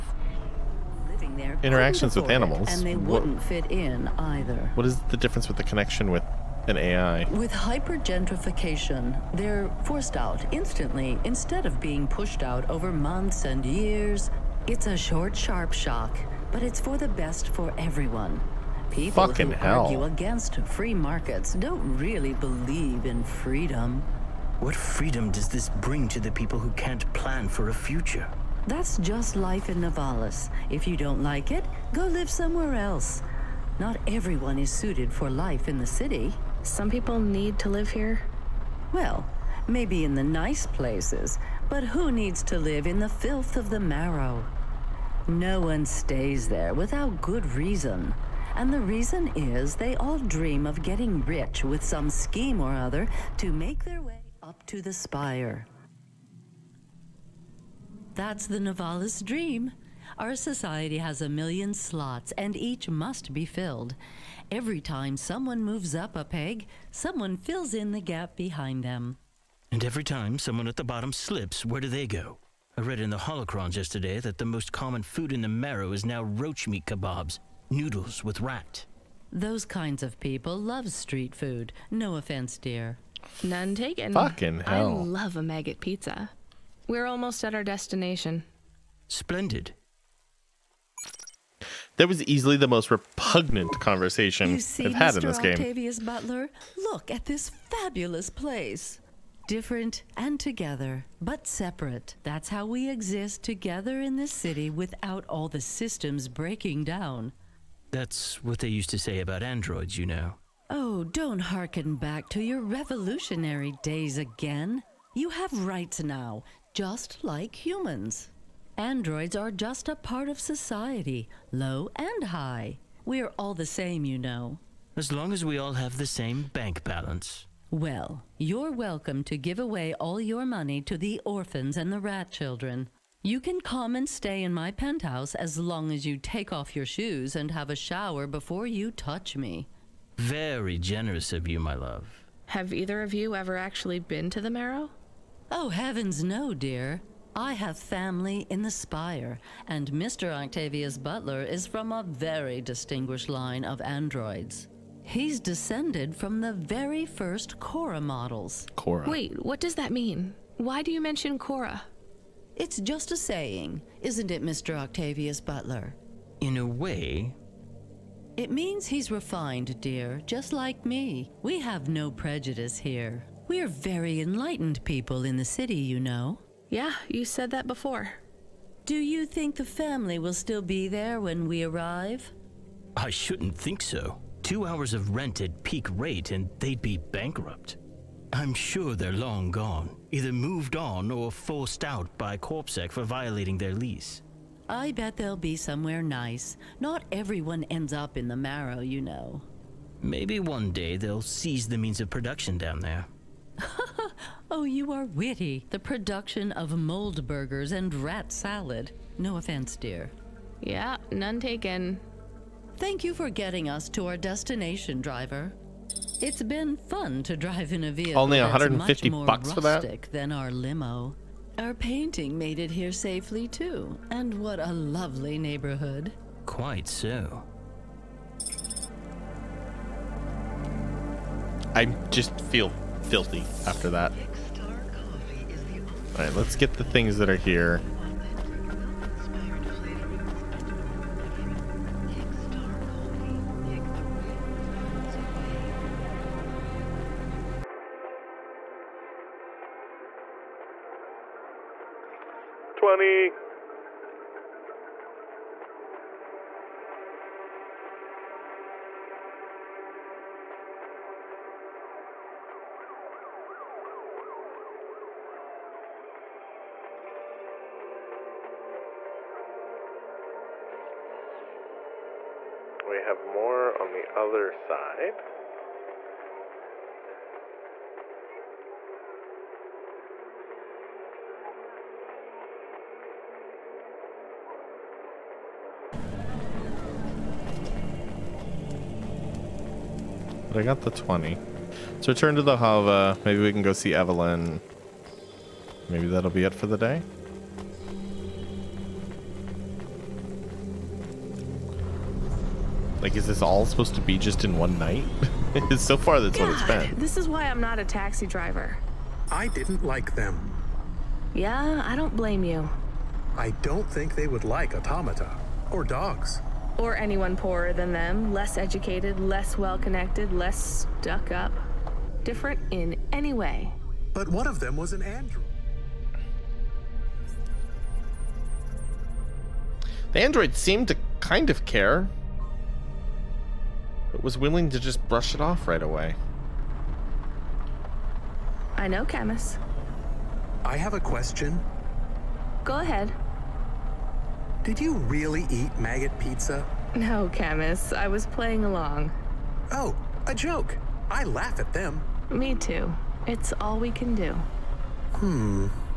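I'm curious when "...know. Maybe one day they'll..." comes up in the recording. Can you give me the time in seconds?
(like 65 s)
199 s.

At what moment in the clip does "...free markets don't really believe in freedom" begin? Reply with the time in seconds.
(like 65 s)
20 s.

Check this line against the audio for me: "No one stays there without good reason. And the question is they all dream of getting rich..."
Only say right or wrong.
wrong.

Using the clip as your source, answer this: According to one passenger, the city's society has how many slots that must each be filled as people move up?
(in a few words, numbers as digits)
a million.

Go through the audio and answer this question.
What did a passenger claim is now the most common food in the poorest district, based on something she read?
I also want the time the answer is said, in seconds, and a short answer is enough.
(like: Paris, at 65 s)
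roach meat kebabs, at 76 s.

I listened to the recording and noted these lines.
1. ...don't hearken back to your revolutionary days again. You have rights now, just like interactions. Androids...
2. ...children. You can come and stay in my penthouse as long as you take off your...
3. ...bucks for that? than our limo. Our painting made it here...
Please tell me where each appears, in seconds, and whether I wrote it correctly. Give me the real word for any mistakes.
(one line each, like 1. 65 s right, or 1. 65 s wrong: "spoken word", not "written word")
1. 111 s wrong: "humans", not "interactions"
2. 132 s right
3. 219 s right.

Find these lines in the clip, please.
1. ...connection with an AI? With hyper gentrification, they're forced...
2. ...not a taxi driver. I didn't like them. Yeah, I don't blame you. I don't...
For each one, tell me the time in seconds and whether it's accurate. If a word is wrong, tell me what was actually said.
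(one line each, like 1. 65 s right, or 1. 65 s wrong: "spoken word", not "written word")
1. 5 s right
2. 307 s right.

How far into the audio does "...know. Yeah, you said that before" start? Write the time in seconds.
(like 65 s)
175 s.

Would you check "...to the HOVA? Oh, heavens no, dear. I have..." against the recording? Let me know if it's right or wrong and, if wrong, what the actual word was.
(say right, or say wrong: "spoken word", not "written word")
wrong: "Marrow", not "HOVA".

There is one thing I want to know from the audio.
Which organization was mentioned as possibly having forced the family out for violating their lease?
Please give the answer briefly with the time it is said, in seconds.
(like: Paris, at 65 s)
Corpsec, at 192 s.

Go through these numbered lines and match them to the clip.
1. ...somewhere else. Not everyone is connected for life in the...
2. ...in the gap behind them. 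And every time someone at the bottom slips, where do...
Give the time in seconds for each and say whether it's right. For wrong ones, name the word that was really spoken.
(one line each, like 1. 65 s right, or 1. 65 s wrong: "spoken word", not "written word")
1. 32 s wrong: "suited", not "connected"
2. 67 s right.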